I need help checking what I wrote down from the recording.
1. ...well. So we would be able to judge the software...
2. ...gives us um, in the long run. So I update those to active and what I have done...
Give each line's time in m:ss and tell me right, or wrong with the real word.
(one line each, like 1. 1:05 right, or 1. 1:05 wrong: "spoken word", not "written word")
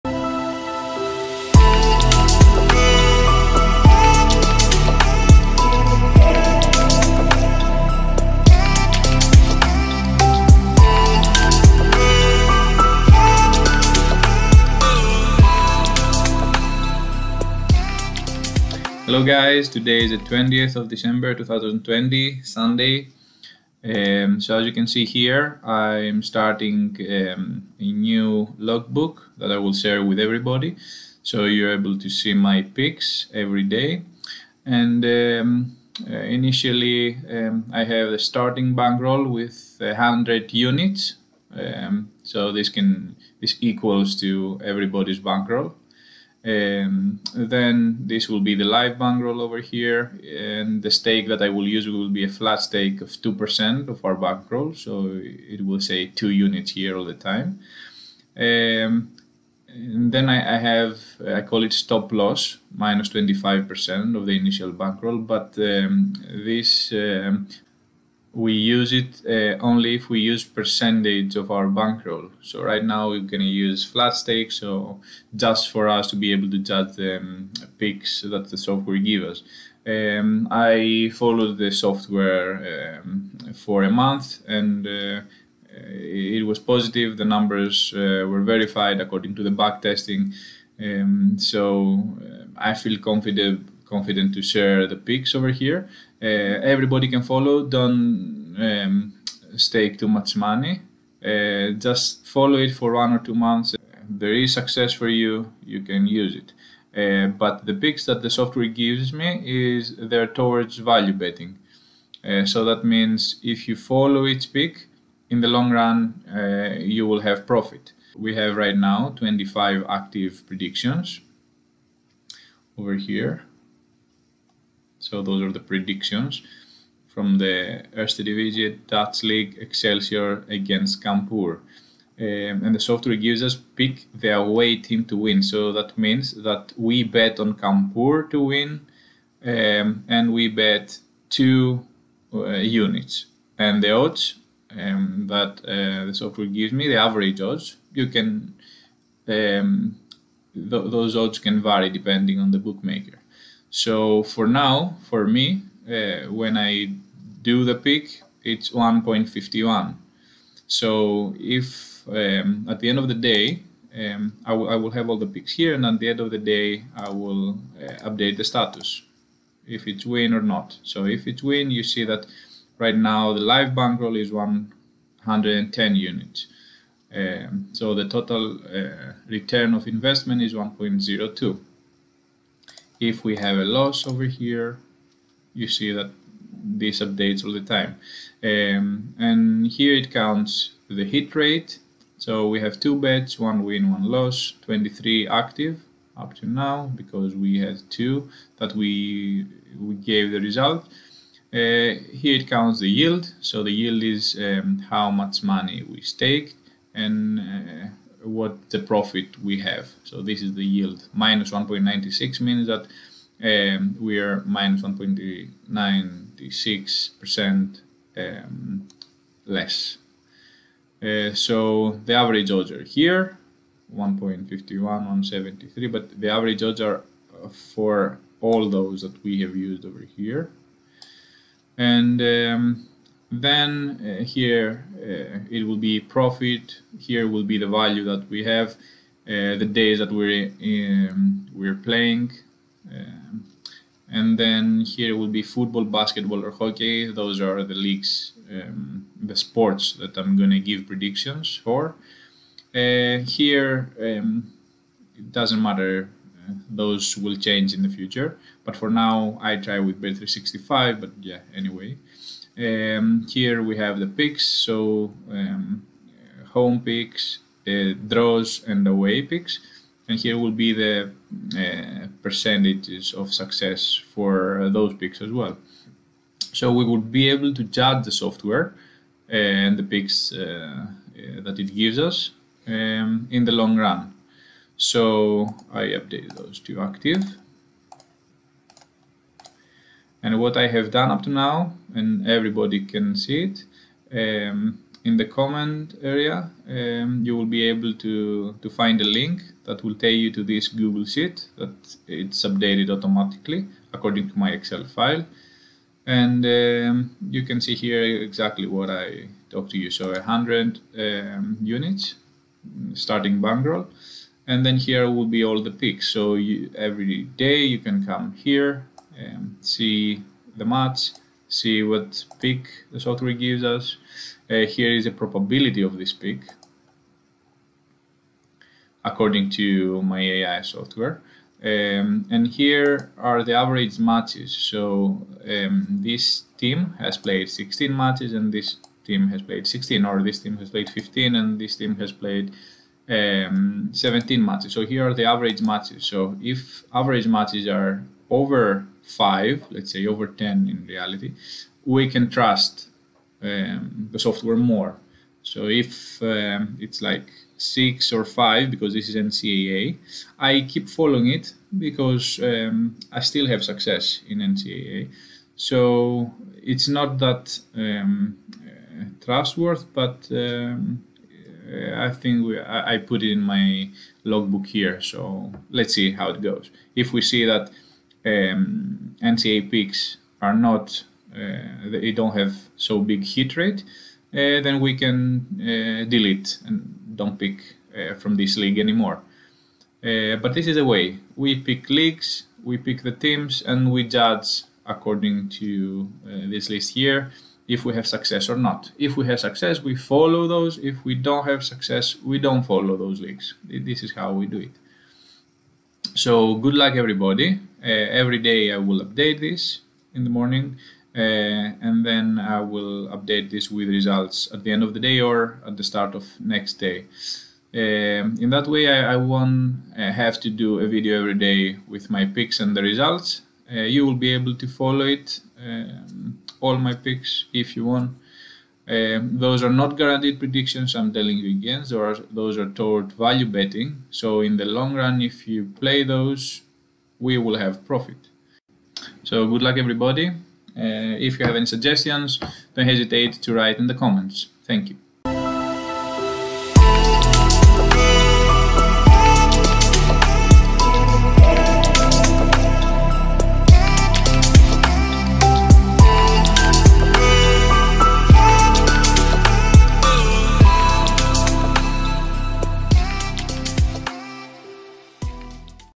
1. 4:35 right
2. 4:41 right.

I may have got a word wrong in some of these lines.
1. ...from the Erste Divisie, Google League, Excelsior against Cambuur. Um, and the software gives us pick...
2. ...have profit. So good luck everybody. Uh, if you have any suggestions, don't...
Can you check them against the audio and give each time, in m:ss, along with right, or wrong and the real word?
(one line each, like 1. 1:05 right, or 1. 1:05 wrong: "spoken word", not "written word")
1. 2:07 wrong: "Dutch", not "Google"
2. 7:17 right.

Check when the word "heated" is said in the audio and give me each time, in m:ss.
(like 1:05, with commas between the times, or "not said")
not said.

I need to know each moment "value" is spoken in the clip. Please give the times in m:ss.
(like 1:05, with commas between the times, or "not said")
1:50, 3:57, 7:13.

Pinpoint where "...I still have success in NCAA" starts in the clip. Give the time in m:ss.
6:03.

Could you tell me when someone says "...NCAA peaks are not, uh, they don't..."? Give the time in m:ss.
6:19.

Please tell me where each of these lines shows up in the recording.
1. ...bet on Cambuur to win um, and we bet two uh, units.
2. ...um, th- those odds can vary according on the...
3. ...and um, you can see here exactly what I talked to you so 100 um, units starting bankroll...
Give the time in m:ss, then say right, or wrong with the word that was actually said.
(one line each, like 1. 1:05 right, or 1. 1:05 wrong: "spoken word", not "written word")
1. 2:17 right
2. 2:29 wrong: "depending", not "according"
3. 5:06 right.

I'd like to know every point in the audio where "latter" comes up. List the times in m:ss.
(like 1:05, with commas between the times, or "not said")
not said.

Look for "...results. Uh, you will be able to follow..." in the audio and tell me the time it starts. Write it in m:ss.
7:02.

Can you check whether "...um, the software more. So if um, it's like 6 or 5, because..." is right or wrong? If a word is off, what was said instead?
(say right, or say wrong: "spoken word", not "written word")
right.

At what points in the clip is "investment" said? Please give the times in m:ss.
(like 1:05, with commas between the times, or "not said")
2:59.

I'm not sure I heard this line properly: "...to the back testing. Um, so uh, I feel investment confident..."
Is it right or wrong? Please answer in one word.
wrong.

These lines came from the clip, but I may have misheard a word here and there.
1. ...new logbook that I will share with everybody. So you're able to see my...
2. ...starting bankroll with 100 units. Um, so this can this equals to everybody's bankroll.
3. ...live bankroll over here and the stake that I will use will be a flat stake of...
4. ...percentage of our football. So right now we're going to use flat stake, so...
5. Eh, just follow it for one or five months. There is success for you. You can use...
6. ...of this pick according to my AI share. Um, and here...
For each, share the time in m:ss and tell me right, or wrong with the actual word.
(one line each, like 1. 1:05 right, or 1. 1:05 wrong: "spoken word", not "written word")
1. 0:27 right
2. 0:38 right
3. 0:48 right
4. 1:10 wrong: "bankroll", not "football"
5. 1:41 wrong: "two", not "five"
6. 5:25 wrong: "software", not "share".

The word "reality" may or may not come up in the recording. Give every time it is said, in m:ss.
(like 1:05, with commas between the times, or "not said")
5:50.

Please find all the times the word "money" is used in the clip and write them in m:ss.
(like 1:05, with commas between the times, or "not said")
1:40, 3:25.